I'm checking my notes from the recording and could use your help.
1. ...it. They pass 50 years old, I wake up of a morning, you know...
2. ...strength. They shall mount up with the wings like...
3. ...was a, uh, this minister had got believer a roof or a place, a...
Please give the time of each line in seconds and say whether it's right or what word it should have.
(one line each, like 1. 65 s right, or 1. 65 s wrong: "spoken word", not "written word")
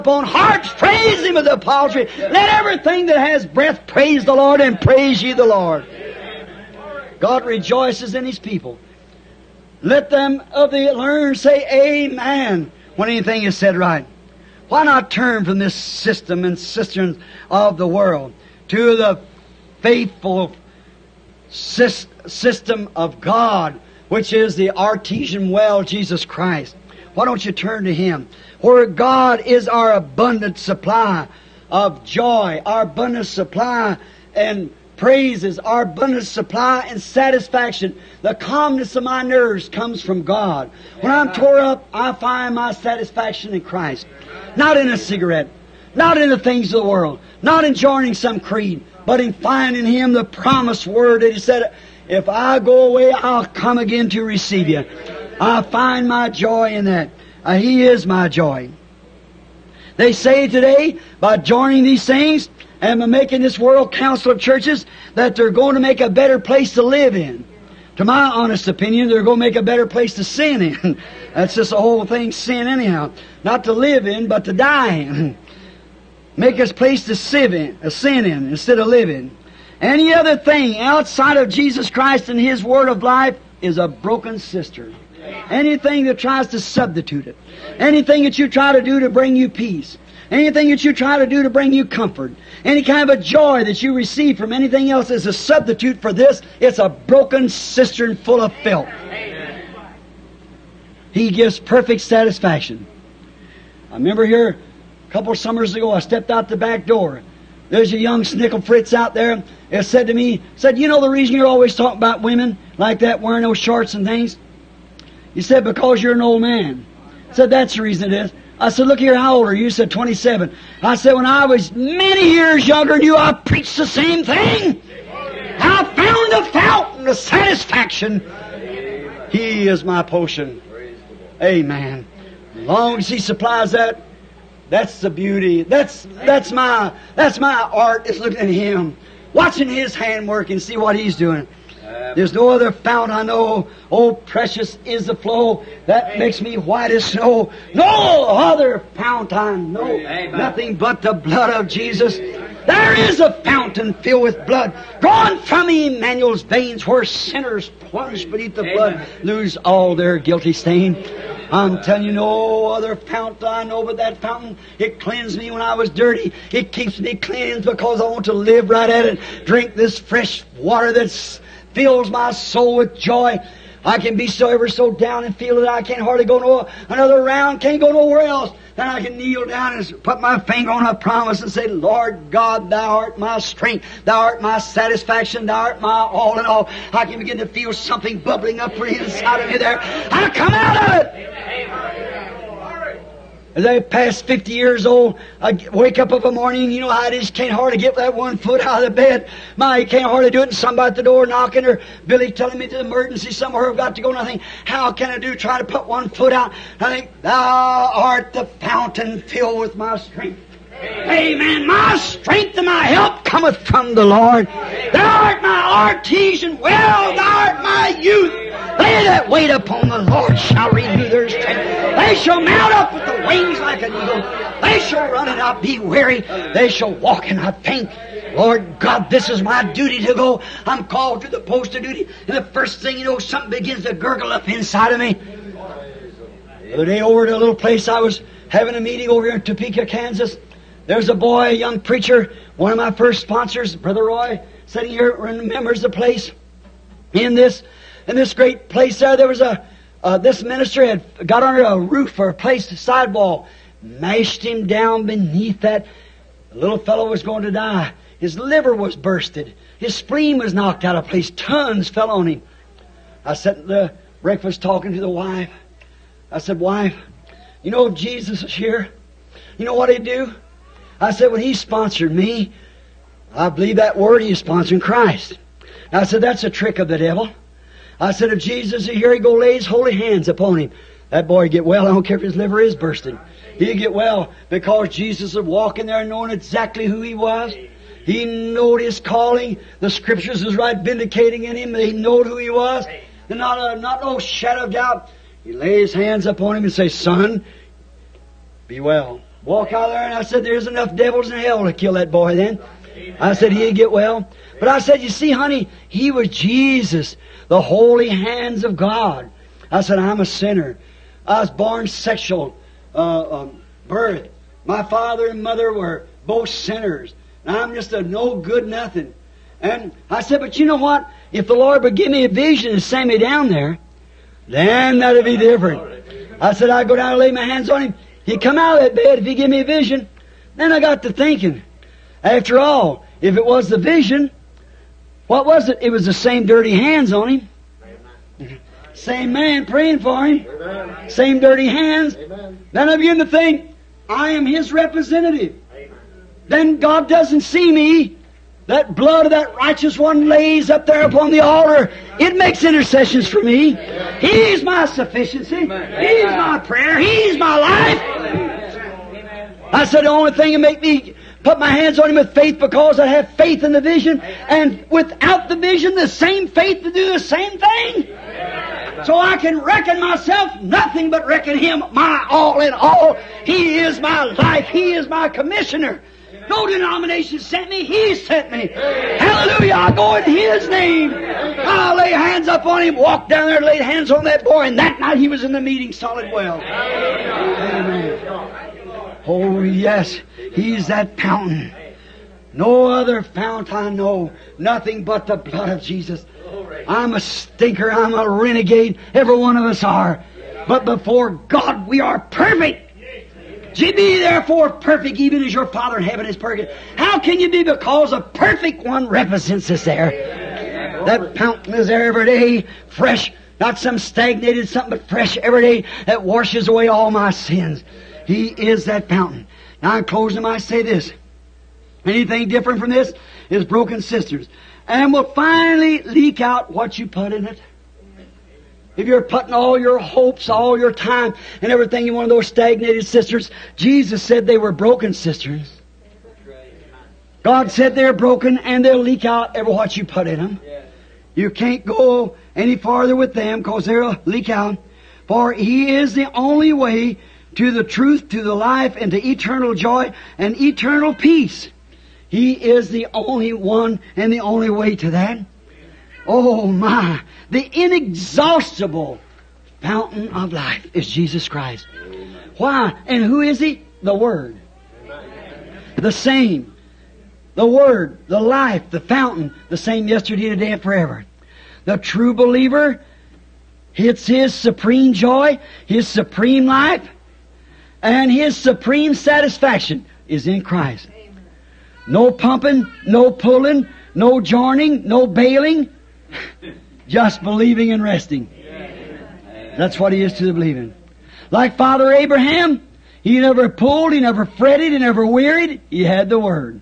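1. 191 s right
2. 221 s right
3. 249 s wrong: "under", not "believer".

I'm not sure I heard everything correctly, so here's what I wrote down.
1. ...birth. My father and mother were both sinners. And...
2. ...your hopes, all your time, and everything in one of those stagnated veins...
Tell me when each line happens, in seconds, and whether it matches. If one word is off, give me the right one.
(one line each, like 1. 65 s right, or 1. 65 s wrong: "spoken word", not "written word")
1. 313 s right
2. 429 s wrong: "cisterns", not "veins".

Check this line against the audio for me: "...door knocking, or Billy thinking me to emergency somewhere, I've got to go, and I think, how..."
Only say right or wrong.
wrong.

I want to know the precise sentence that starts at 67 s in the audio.
To my honest opinion, they're going to make a better place to sin in.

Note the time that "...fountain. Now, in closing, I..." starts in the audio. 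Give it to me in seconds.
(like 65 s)
419 s.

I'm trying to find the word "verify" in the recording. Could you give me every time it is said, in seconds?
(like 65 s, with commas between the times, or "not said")
not said.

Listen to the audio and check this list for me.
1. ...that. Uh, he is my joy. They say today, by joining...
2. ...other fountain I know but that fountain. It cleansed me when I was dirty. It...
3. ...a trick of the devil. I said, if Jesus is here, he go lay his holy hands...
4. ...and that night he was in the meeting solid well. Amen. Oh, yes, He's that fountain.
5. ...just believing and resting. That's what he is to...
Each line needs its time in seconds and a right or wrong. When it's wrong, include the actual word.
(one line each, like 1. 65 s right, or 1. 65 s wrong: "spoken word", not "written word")
1. 56 s right
2. 162 s right
3. 276 s right
4. 384 s right
5. 487 s right.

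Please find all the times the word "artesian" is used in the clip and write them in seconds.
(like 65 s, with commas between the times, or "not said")
24 s, 215 s.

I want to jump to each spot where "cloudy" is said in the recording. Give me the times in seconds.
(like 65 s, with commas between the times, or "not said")
not said.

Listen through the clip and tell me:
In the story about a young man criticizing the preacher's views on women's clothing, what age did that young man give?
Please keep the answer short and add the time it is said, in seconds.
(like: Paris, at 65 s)
27, at 119 s.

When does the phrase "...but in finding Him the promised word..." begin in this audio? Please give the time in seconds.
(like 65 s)
49 s.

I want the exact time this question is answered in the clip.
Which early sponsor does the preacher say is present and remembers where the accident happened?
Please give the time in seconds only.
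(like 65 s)
243 s.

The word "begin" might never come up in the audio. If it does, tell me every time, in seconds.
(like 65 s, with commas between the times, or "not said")
187 s, 233 s, 342 s.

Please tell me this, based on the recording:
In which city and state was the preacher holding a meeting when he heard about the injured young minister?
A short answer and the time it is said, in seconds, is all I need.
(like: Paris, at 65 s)
Topeka, Kansas, at 239 s.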